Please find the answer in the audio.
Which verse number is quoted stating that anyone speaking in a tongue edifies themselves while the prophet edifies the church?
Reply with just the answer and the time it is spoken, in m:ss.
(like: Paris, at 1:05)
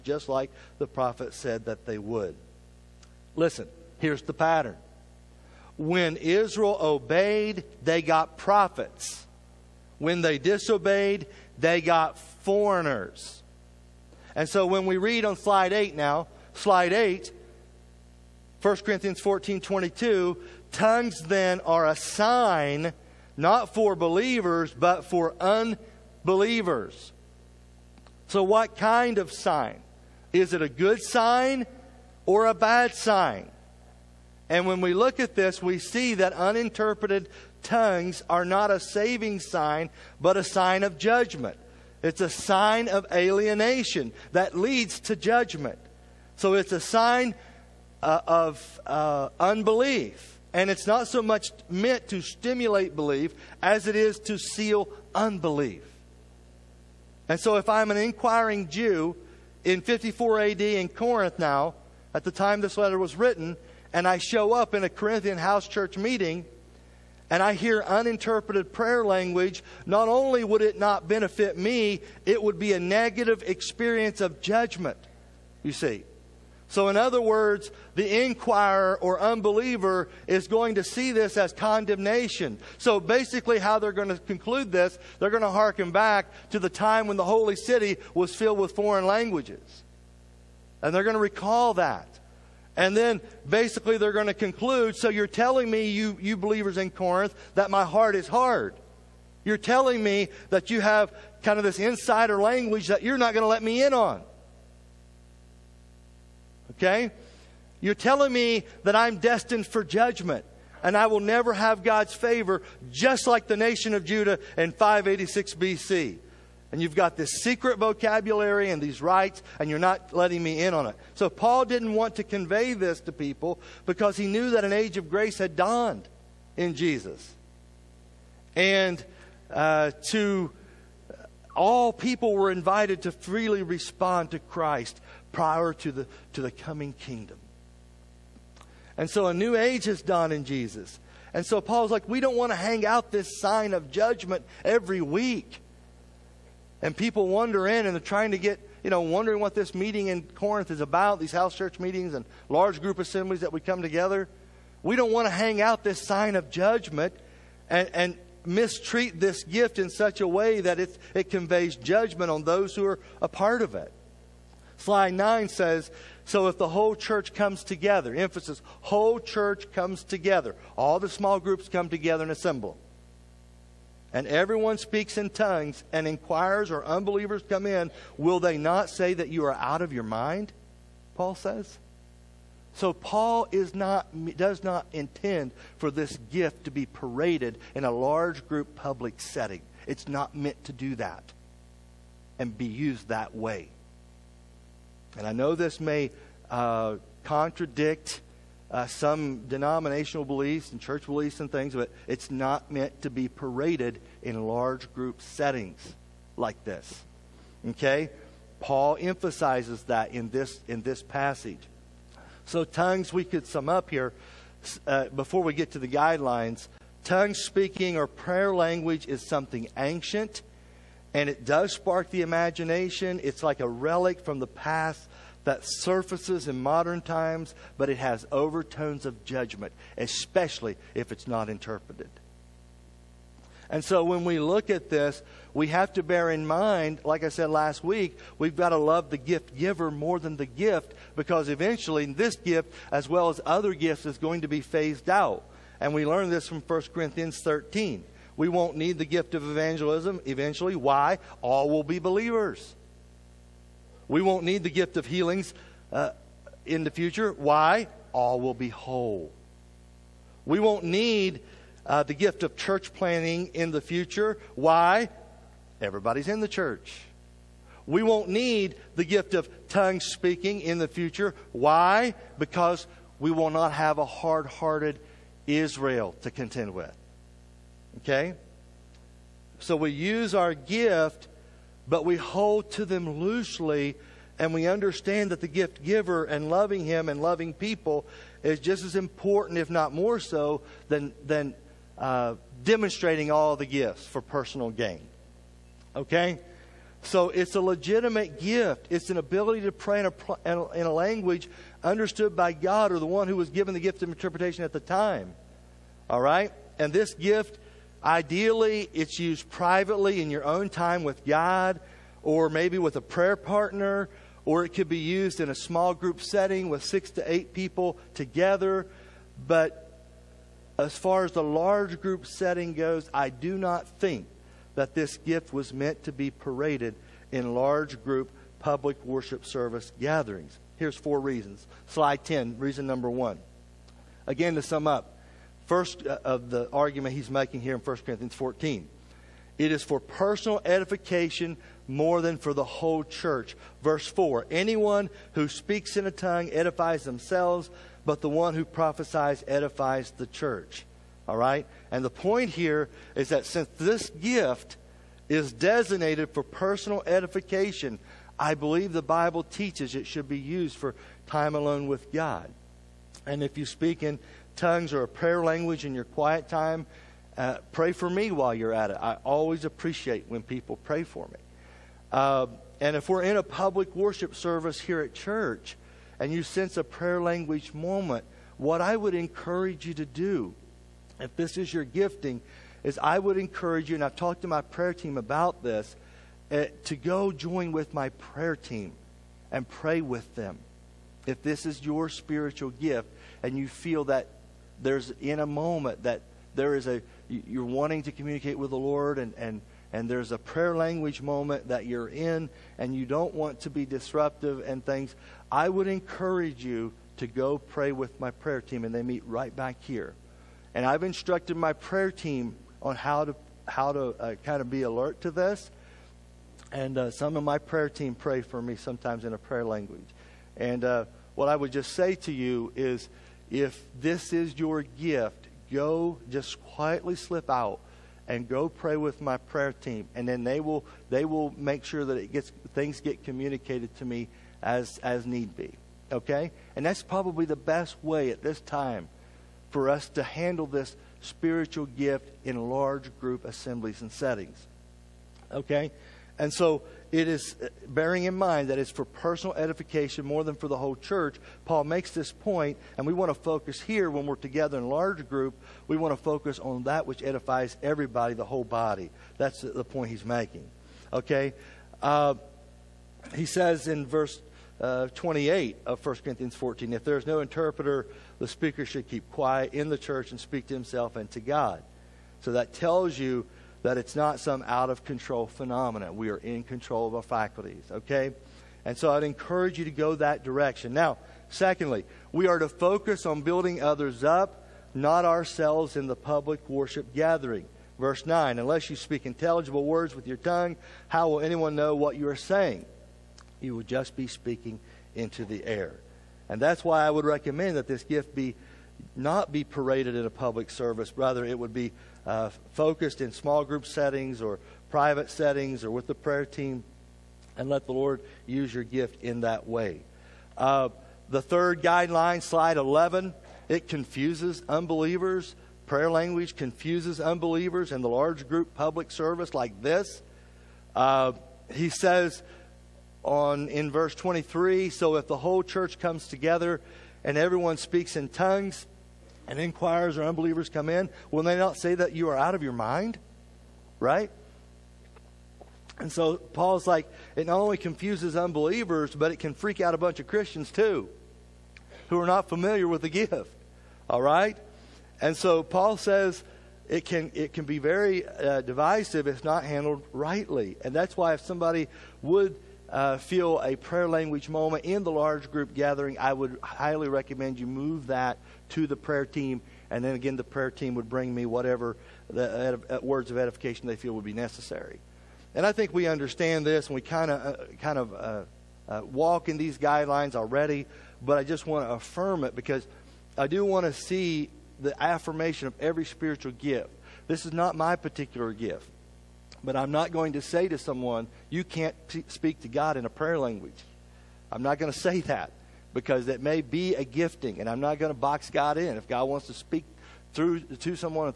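Verse 4, at 5:43.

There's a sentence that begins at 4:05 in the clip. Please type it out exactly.
And we learn this from 1 Corinthians 13.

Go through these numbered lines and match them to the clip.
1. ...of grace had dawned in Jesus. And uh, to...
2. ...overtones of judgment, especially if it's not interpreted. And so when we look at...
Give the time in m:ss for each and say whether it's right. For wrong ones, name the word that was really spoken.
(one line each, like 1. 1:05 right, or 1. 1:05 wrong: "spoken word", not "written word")
1. 2:04 right
2. 3:48 right.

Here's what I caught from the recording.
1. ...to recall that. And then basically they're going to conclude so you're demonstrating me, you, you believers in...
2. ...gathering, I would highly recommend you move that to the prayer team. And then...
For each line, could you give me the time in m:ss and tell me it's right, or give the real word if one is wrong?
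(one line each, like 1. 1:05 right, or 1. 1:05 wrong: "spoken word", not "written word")
1. 1:31 wrong: "telling", not "demonstrating"
2. 9:15 right.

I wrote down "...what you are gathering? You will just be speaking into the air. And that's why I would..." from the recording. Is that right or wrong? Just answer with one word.
wrong.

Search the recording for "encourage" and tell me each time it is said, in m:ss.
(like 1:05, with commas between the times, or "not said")
6:19, 6:23, 6:45, 7:59.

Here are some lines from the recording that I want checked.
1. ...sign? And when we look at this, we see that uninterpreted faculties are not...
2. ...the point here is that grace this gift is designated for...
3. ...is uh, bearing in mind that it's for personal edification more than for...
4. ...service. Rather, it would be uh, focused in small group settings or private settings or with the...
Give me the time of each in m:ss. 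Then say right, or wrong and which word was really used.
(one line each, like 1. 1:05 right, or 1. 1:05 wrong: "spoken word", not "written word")
1. 0:32 wrong: "tongues", not "faculties"
2. 5:52 wrong: "since", not "grace"
3. 7:27 right
4. 8:20 right.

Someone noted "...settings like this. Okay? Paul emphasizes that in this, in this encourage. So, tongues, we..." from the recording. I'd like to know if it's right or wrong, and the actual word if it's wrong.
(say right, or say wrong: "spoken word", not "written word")
wrong: "passage", not "encourage".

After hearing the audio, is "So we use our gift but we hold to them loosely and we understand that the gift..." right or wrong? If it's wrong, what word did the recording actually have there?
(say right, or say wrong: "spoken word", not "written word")
right.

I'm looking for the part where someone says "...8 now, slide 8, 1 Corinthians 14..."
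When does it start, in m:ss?
0:15.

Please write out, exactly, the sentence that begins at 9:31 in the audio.
But I just want to affirm it because I do want to see the affirmation of every spiritual gift.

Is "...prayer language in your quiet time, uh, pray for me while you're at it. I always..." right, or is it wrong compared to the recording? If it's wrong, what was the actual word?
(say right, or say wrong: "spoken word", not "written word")
right.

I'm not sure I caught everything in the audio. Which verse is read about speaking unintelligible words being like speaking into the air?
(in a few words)
Verse 9.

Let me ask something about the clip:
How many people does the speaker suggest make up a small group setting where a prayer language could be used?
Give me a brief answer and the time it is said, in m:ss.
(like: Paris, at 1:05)
6 to 8, at 5:16.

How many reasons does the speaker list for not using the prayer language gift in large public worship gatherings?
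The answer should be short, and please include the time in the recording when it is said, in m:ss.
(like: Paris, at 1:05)
4, at 5:30.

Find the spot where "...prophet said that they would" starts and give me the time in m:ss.
0:00.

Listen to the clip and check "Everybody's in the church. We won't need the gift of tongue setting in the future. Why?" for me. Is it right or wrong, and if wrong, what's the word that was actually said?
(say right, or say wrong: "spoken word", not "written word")
wrong: "speaking", not "setting".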